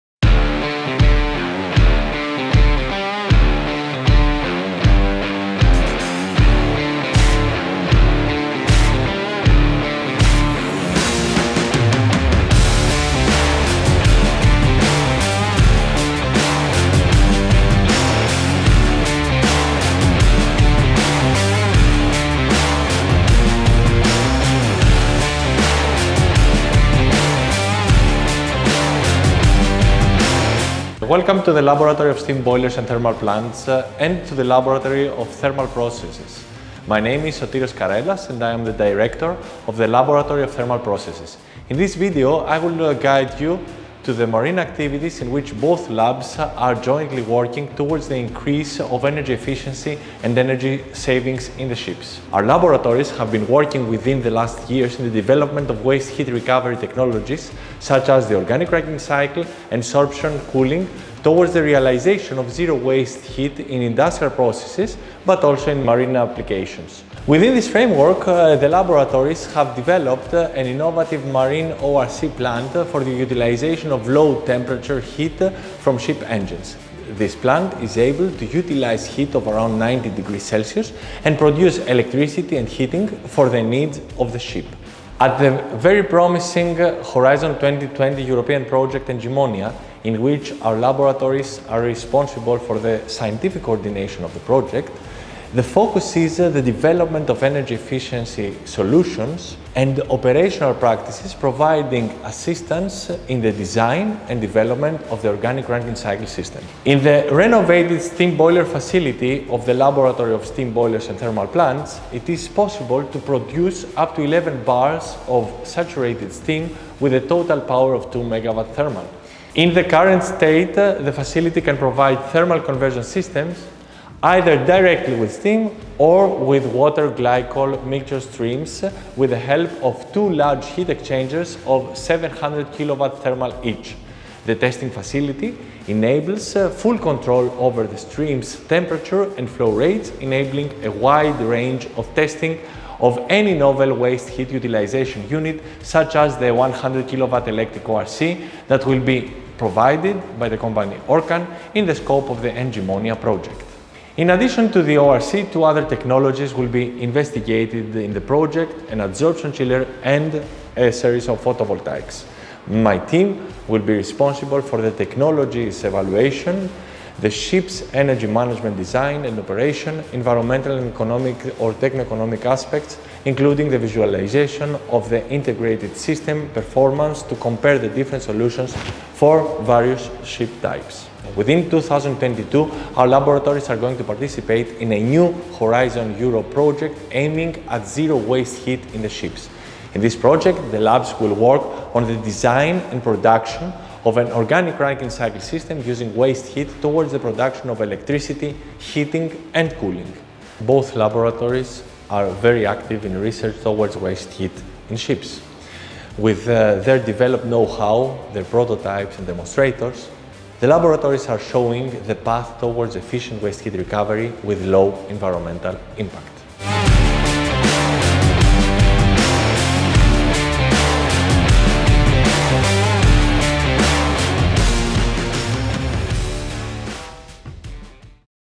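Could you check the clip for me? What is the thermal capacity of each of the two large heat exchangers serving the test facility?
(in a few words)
700 kilowatt thermal.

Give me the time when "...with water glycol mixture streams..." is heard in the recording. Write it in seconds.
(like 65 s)
126 s.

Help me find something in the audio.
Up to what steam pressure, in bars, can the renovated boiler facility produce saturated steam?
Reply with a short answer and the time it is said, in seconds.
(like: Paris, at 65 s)
11 bars, at 114 s.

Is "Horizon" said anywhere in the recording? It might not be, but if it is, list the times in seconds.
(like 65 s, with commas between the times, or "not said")
87 s, 185 s.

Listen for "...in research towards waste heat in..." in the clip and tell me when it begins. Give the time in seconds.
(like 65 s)
203 s.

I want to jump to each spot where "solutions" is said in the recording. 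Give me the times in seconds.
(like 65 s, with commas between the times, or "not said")
98 s, 178 s.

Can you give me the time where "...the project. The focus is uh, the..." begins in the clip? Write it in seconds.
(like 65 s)
94 s.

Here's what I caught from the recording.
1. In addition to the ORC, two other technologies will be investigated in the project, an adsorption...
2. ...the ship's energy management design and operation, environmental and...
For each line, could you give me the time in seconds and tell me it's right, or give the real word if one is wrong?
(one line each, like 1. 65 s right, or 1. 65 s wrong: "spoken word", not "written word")
1. 154 s right
2. 167 s right.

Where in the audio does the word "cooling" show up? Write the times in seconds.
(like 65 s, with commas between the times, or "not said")
60 s, 199 s.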